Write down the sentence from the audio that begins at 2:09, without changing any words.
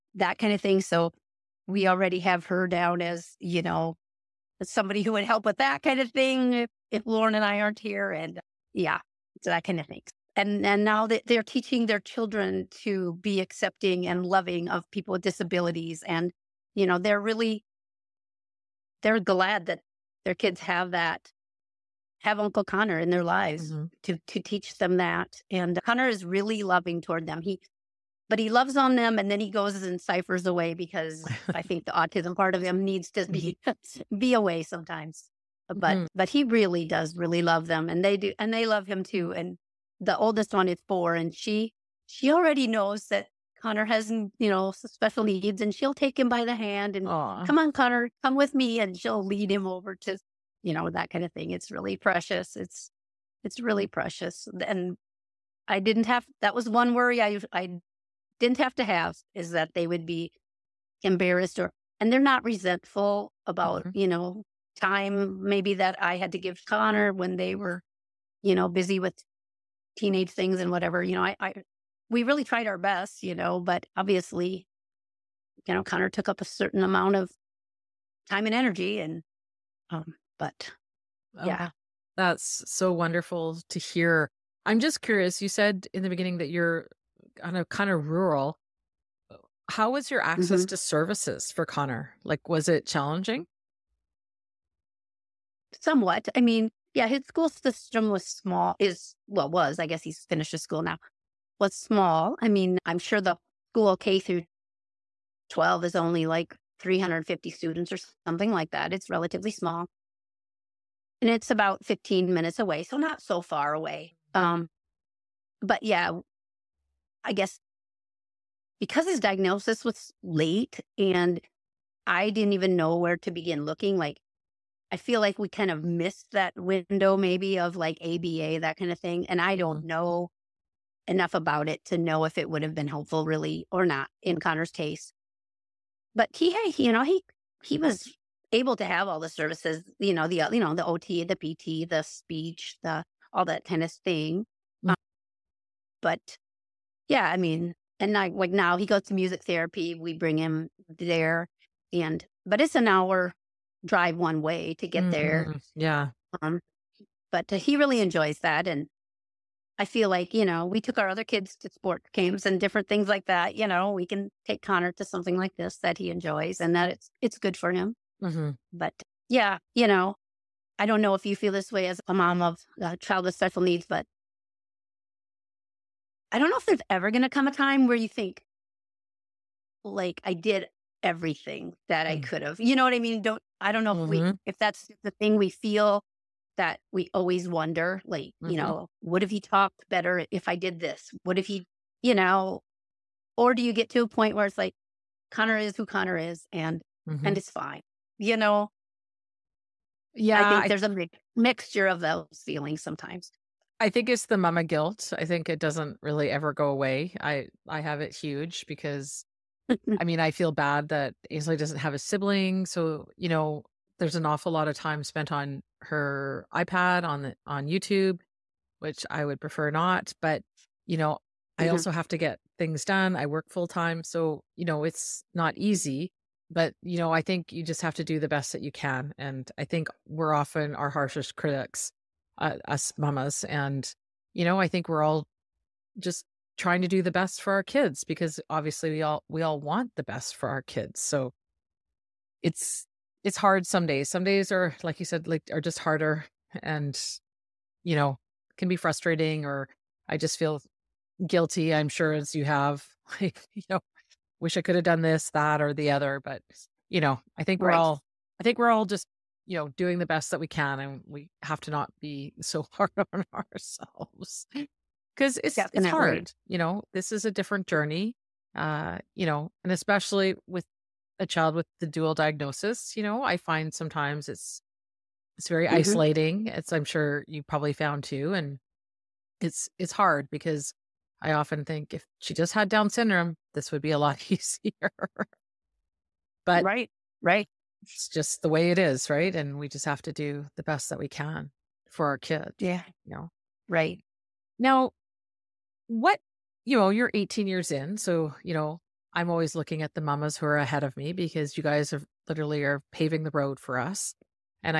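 don't know enough about it to know if it would have been helpful really or not in Connor's case.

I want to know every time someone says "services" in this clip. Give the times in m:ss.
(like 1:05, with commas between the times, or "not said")
1:30, 2:19.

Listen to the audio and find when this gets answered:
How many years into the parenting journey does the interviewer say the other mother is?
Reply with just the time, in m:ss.
4:57.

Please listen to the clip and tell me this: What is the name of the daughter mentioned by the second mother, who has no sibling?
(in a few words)
Ainsley.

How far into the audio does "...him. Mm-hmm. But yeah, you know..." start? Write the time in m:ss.
2:47.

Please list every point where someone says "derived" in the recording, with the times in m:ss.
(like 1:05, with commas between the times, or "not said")
not said.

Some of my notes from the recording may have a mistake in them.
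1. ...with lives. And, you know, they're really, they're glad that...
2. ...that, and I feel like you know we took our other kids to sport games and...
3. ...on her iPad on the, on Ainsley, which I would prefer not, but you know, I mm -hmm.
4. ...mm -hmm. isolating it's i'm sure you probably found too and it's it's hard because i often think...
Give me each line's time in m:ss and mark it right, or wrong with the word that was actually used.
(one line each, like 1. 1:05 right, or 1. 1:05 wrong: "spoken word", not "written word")
1. 0:15 wrong: "disabilities", not "lives"
2. 2:38 right
3. 3:35 wrong: "YouTube", not "Ainsley"
4. 4:35 right.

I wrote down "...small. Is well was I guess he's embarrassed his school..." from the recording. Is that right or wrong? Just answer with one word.
wrong.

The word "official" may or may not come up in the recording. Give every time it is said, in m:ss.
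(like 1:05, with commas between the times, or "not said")
not said.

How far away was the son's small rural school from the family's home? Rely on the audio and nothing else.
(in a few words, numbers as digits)
15 minutes.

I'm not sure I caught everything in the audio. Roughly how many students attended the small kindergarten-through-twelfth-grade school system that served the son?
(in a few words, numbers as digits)
350.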